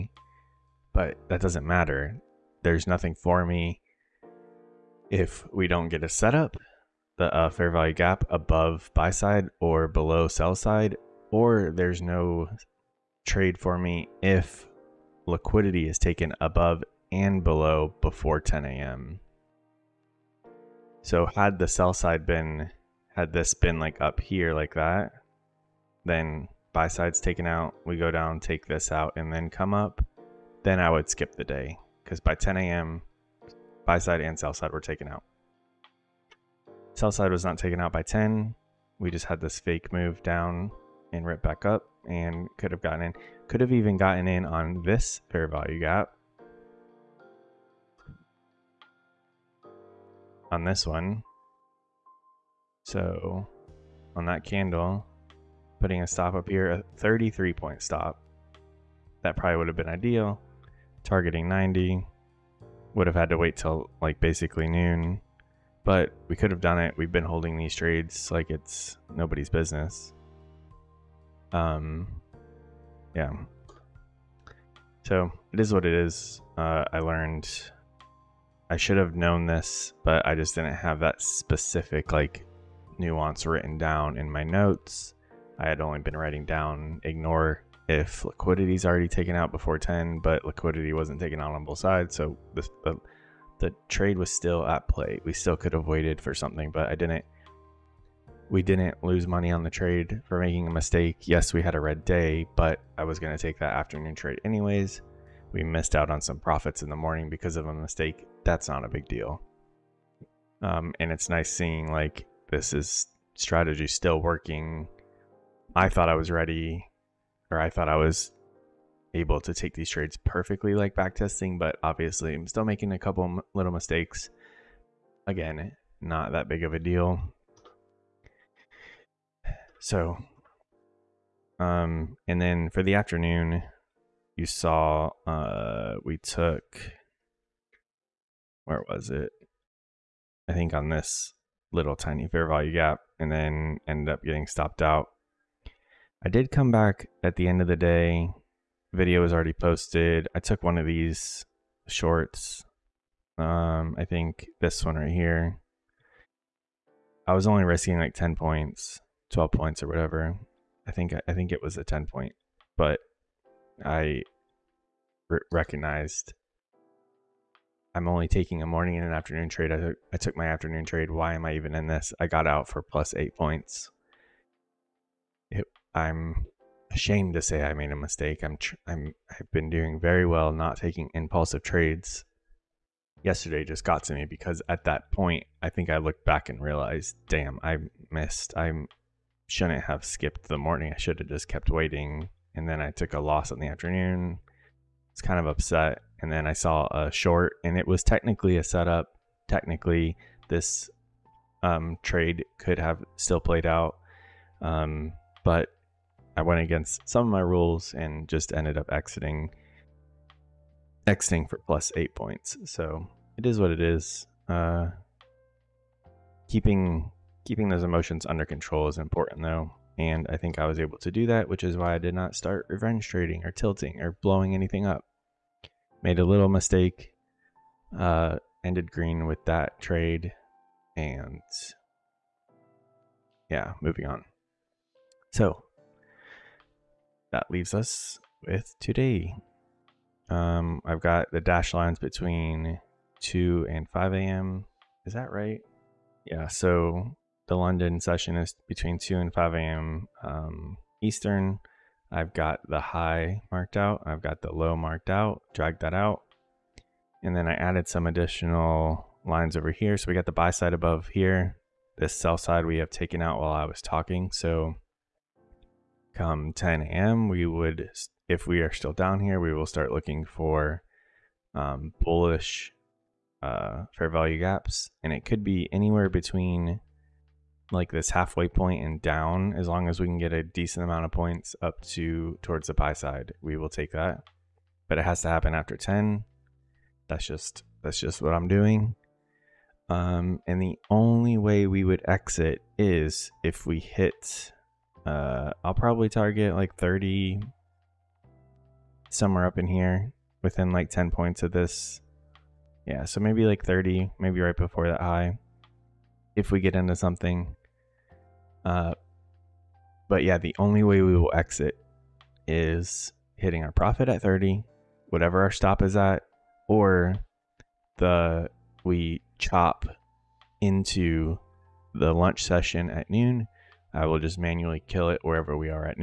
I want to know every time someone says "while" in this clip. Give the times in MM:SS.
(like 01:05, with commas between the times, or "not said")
04:23.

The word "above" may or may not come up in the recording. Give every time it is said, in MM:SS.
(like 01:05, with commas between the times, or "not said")
00:08, 00:16, 04:20.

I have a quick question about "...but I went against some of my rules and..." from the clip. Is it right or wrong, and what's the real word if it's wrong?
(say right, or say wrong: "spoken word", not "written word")
right.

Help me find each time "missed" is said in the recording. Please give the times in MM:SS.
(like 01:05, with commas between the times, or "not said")
01:45, 03:08.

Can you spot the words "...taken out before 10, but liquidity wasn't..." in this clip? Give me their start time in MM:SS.
01:29.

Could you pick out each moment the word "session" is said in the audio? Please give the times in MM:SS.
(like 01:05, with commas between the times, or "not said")
04:07, 05:22.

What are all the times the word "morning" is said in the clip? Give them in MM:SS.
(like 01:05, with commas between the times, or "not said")
01:46, 02:48, 03:10.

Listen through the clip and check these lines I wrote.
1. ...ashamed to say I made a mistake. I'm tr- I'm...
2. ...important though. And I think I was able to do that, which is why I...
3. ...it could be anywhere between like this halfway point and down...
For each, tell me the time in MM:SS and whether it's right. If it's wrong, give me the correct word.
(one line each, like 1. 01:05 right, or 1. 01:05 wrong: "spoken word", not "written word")
1. 02:56 right
2. 03:38 right
3. 04:35 right.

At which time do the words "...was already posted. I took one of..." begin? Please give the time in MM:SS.
02:29.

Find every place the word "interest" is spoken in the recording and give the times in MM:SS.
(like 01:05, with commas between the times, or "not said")
not said.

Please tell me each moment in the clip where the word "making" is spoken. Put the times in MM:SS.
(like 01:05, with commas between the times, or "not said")
01:40, 02:02.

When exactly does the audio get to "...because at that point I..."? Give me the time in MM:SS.
03:04.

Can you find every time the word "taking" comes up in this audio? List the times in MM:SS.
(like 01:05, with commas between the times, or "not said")
02:48, 03:00.